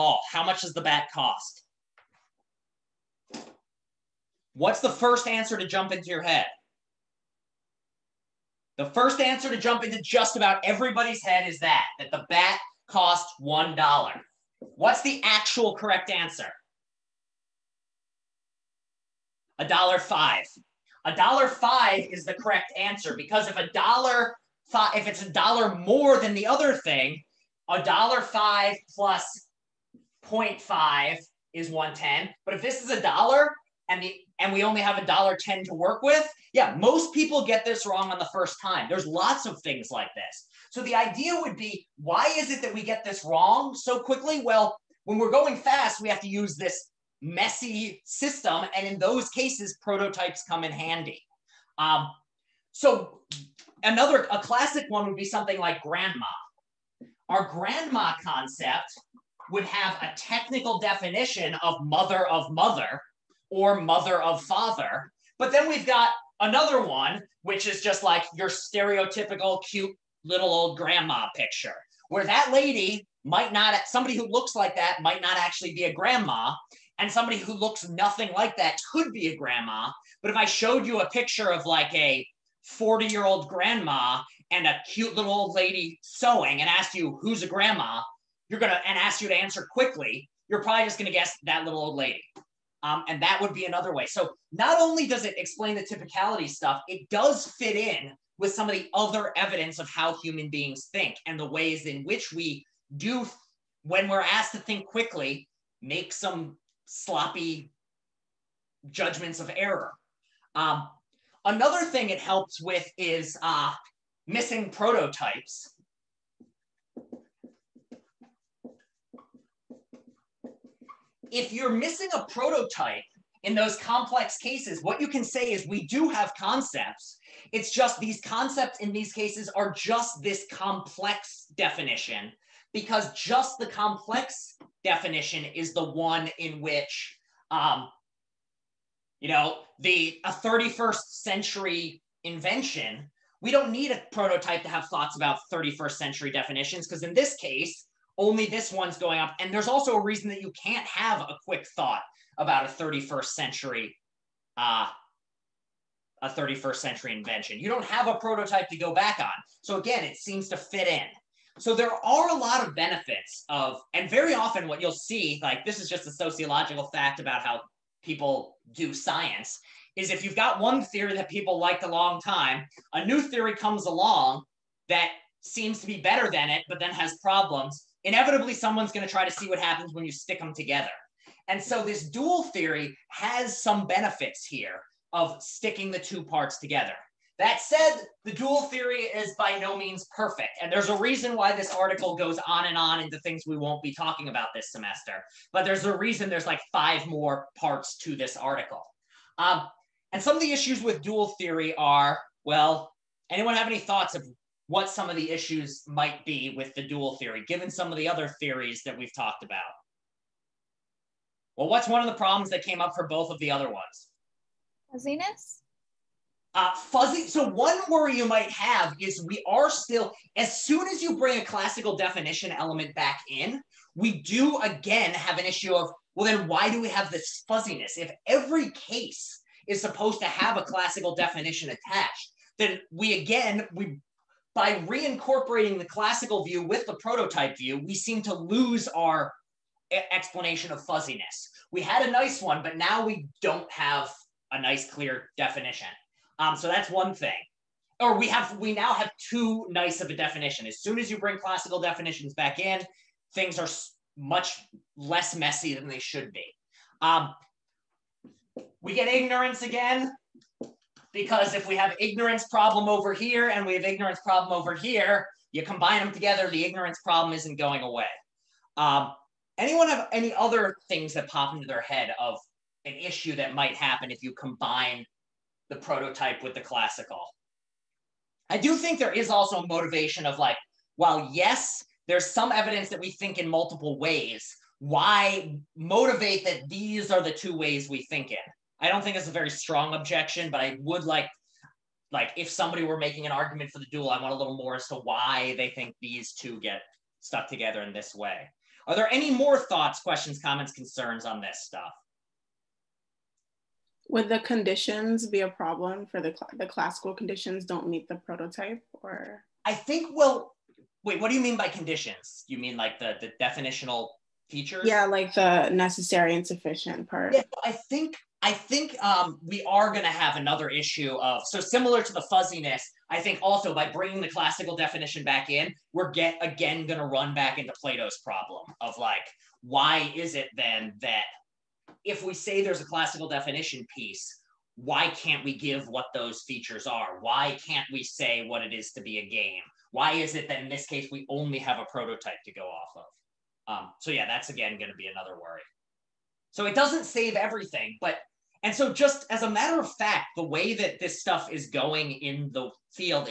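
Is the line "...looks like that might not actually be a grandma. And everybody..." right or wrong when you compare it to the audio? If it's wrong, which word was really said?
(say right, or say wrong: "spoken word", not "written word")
wrong: "somebody", not "everybody".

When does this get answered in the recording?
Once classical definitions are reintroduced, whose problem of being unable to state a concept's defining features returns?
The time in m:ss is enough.
5:27.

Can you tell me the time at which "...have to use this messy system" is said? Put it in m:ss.
0:46.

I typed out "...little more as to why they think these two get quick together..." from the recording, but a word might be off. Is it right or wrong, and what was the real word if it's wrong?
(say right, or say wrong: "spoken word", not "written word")
wrong: "stuck", not "quick".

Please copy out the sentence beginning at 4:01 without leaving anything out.
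We had a nice one, but now we don't have a nice, clear definition.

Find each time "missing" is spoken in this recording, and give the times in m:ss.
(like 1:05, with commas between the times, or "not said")
1:54, 2:01.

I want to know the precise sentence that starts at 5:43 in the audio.
Um, so yeah, that's again going to be another worry.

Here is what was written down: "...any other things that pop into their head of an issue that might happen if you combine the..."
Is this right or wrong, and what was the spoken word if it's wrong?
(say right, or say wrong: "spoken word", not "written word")
right.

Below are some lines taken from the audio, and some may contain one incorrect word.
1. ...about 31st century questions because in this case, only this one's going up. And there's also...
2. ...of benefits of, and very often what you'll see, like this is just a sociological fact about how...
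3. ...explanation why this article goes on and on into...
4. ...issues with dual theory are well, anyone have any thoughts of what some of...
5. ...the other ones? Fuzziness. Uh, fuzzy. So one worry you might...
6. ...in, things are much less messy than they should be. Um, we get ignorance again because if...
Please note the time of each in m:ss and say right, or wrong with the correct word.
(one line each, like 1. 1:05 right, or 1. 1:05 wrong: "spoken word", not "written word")
1. 2:25 wrong: "definitions", not "questions"
2. 2:42 right
3. 3:10 wrong: "reason", not "explanation"
4. 3:20 right
5. 3:33 right
6. 4:12 right.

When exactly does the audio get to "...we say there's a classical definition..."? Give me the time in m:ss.
5:32.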